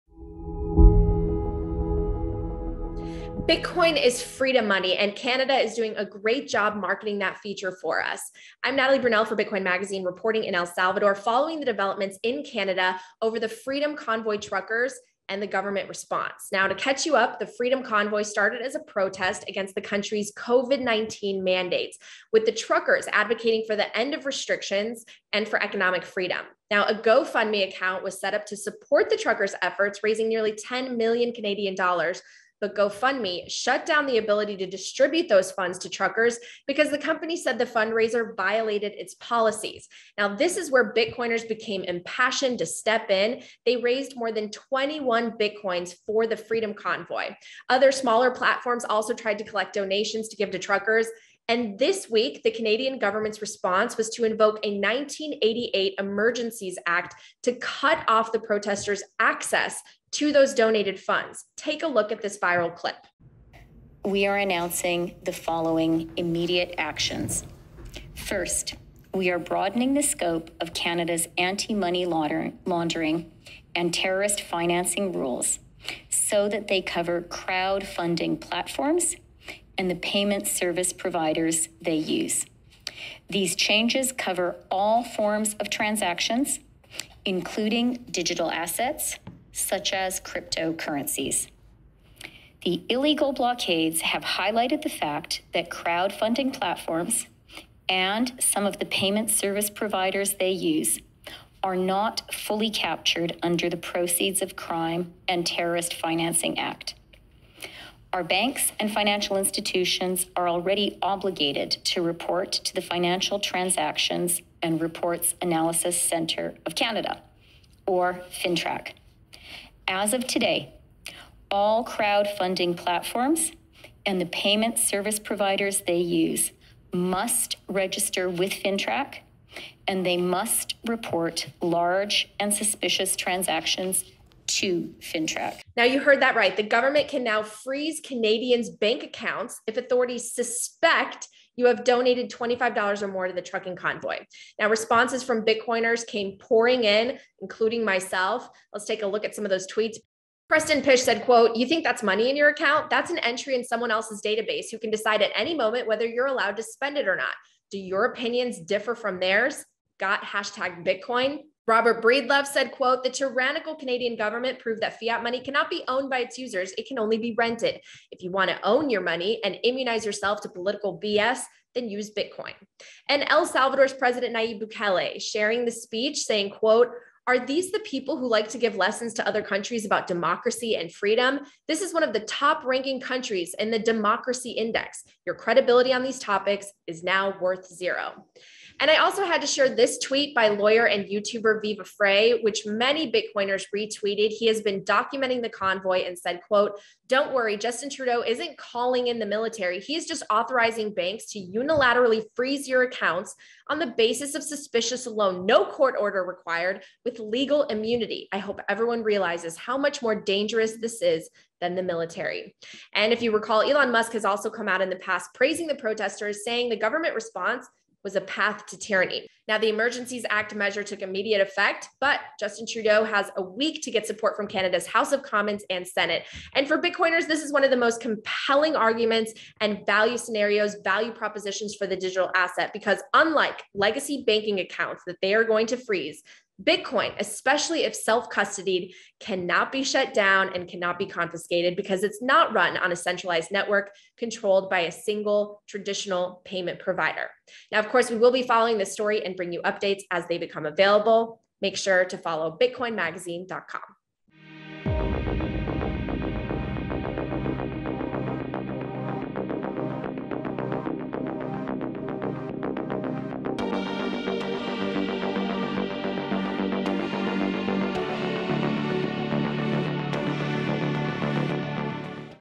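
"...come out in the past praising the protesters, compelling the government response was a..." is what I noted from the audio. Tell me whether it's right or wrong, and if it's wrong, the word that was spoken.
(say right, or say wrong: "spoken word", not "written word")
wrong: "saying", not "compelling".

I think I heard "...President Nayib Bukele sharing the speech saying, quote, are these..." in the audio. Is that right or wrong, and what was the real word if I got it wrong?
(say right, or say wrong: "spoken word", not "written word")
right.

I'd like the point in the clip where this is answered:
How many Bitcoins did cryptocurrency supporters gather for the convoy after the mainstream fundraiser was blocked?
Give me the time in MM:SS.
00:44.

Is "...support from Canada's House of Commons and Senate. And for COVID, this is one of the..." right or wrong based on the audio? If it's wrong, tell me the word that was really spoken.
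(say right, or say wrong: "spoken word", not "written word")
wrong: "Bitcoiners", not "COVID".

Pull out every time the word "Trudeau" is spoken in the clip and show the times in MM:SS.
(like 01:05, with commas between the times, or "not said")
03:17, 03:42.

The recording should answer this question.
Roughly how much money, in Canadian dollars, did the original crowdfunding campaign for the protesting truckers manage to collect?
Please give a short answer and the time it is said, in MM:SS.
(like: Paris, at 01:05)
nearly 10 million Canadian dollars, at 00:30.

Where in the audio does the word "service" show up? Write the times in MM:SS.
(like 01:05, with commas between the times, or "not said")
01:20, 01:39, 02:04.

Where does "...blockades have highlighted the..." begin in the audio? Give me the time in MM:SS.
01:33.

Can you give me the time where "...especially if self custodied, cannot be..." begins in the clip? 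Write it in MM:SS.
03:57.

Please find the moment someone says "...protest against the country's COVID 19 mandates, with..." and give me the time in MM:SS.
00:18.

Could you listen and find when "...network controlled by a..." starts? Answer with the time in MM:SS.
04:03.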